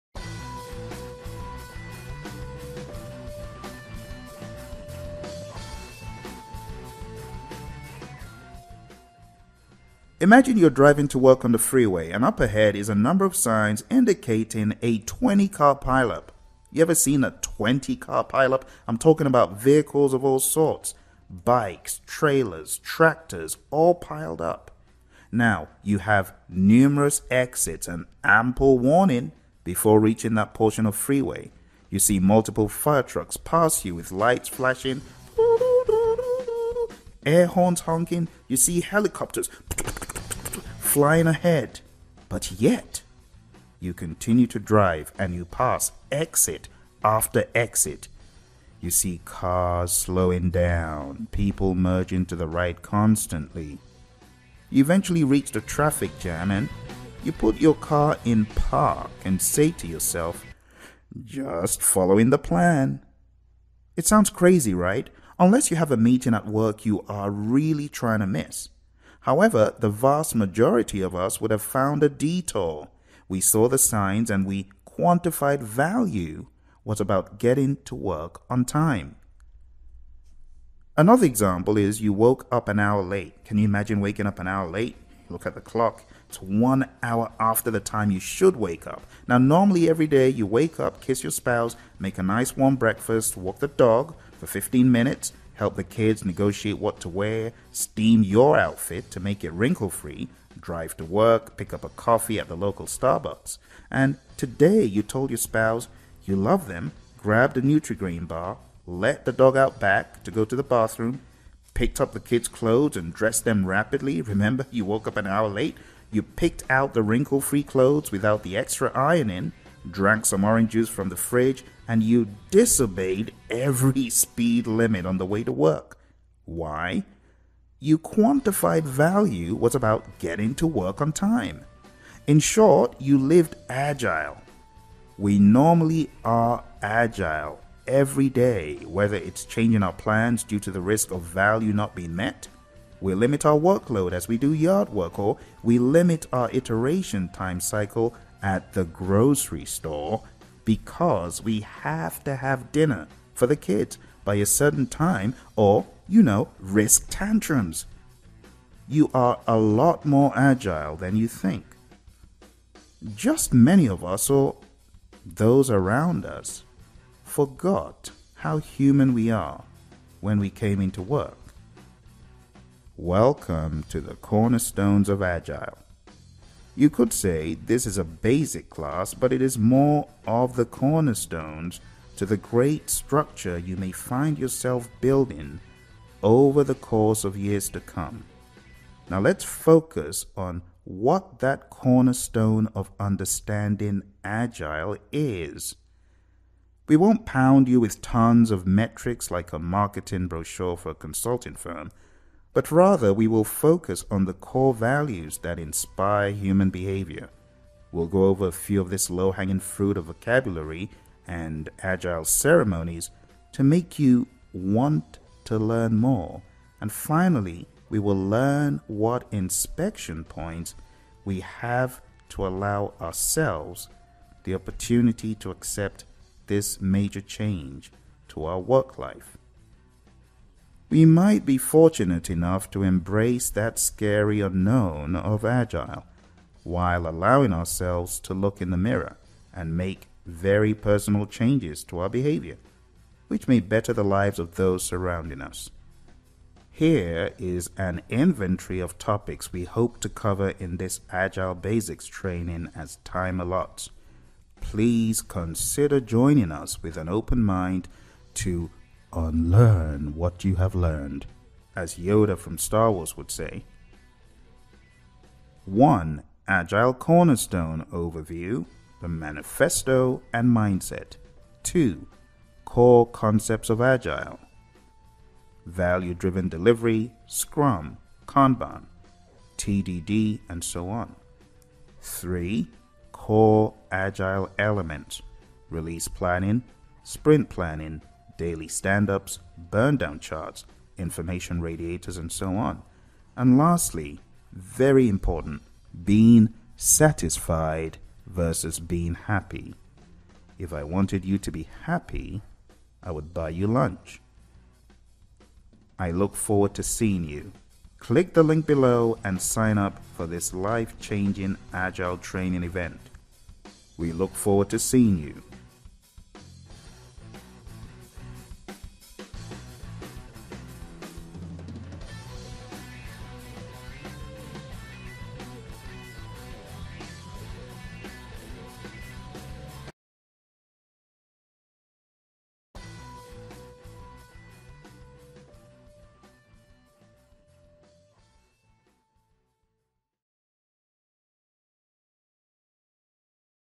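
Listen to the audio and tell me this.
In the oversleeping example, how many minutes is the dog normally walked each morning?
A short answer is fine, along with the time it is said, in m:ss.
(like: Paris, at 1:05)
15, at 1:34.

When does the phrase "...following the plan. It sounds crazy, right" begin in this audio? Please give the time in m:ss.
1:01.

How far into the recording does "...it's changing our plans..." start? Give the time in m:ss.
2:19.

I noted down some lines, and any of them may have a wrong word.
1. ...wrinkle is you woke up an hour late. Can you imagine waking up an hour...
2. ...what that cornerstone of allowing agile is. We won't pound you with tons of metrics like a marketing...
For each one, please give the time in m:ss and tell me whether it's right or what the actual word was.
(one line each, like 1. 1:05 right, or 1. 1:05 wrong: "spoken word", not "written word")
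1. 1:21 wrong: "example", not "wrinkle"
2. 3:10 wrong: "understanding", not "allowing".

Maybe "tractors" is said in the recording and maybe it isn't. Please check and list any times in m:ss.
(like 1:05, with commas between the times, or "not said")
0:22.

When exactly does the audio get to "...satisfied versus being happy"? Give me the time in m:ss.
4:56.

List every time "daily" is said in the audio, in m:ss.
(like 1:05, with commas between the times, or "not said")
4:48.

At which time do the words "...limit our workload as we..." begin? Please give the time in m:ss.
2:23.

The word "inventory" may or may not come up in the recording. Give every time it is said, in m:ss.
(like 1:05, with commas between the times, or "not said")
4:08.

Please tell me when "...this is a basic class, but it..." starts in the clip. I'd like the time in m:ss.
2:57.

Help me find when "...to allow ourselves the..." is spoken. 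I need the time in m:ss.
3:42.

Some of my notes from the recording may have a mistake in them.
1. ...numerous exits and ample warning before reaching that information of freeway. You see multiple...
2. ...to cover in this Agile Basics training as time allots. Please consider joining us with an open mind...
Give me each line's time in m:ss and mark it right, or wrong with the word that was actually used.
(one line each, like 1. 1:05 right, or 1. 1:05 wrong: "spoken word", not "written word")
1. 0:26 wrong: "portion", not "information"
2. 4:10 right.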